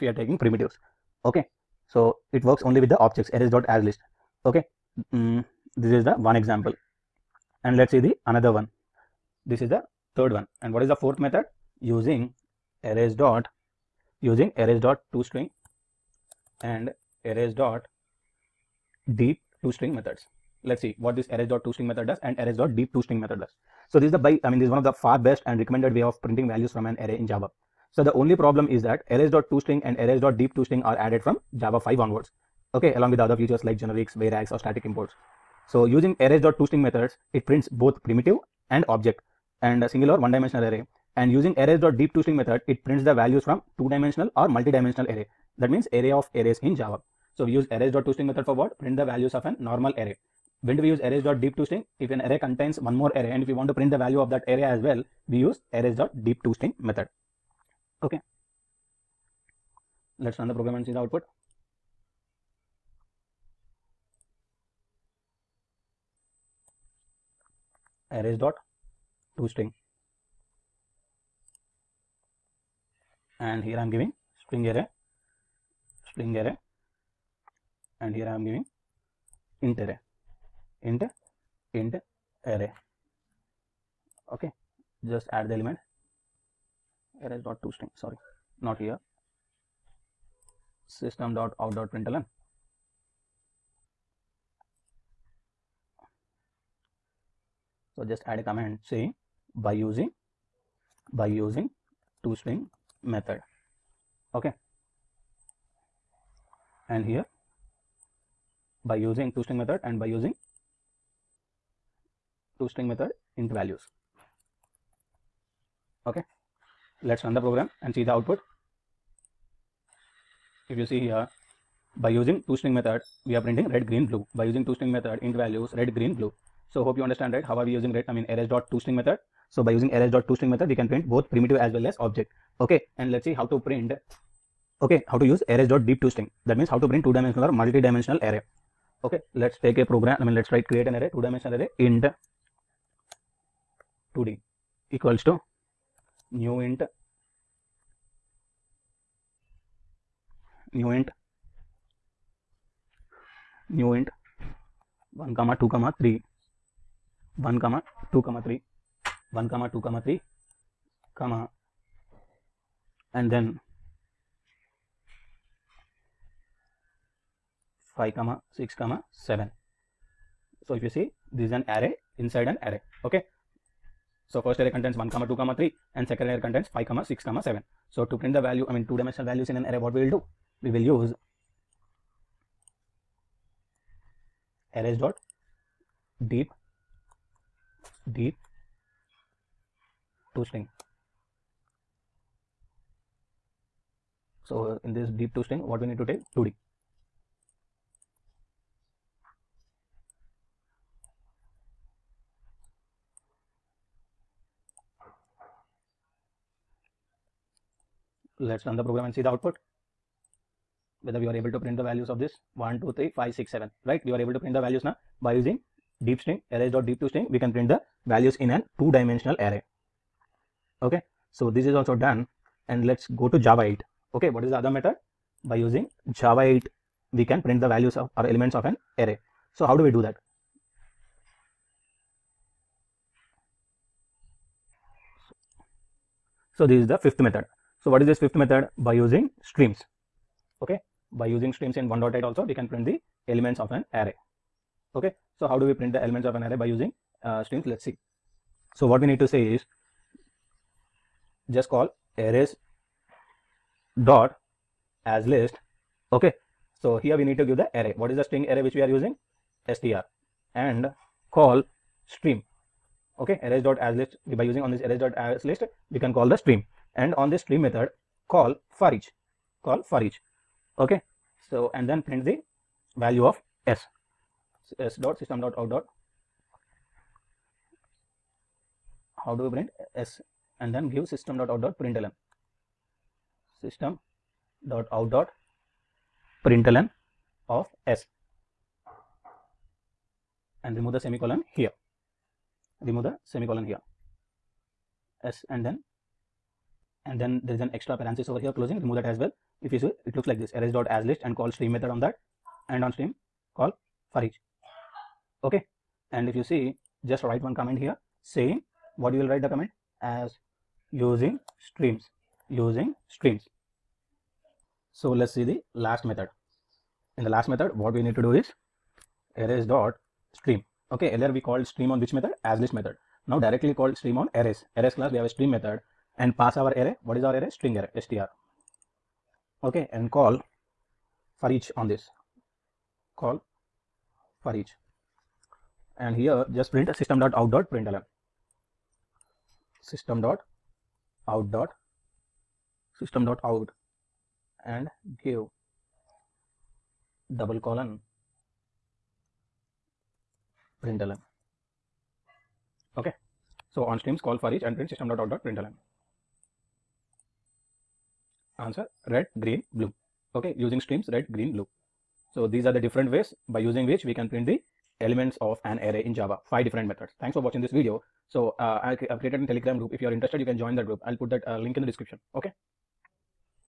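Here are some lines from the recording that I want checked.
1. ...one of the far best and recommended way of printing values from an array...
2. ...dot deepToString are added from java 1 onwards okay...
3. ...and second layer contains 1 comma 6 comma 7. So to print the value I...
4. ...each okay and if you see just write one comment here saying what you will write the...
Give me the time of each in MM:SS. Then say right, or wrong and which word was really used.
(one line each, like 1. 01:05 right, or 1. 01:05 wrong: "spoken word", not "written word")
1. 00:24 right
2. 00:30 wrong: "5", not "1"
3. 02:55 wrong: "5", not "1"
4. 05:04 right.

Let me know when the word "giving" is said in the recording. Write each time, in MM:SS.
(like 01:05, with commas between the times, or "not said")
01:13, 01:18.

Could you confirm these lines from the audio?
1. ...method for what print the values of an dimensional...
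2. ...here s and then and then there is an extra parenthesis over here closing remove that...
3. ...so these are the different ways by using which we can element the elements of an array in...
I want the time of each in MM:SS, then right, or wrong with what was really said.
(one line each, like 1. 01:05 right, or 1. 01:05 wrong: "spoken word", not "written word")
1. 00:48 wrong: "normal", not "dimensional"
2. 04:53 right
3. 06:02 wrong: "print", not "element".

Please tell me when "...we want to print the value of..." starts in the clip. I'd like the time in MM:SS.
00:53.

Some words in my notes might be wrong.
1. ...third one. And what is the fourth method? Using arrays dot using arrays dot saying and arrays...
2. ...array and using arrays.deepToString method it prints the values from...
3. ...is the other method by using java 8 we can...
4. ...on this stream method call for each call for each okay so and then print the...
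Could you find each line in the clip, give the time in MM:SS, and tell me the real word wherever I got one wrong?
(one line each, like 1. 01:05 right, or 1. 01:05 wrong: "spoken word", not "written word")
1. 00:10 wrong: "toString", not "saying"
2. 00:40 right
3. 03:44 right
4. 04:27 right.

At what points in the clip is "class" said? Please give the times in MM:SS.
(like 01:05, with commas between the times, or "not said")
05:24.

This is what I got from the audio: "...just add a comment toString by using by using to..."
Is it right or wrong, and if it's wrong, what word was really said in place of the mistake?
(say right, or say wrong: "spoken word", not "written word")
wrong: "saying", not "toString".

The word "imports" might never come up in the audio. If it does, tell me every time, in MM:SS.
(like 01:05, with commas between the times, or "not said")
00:34.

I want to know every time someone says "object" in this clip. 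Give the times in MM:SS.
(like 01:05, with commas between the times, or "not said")
00:02, 00:38, 02:11.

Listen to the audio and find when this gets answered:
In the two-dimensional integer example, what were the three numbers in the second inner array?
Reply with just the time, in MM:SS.
02:47.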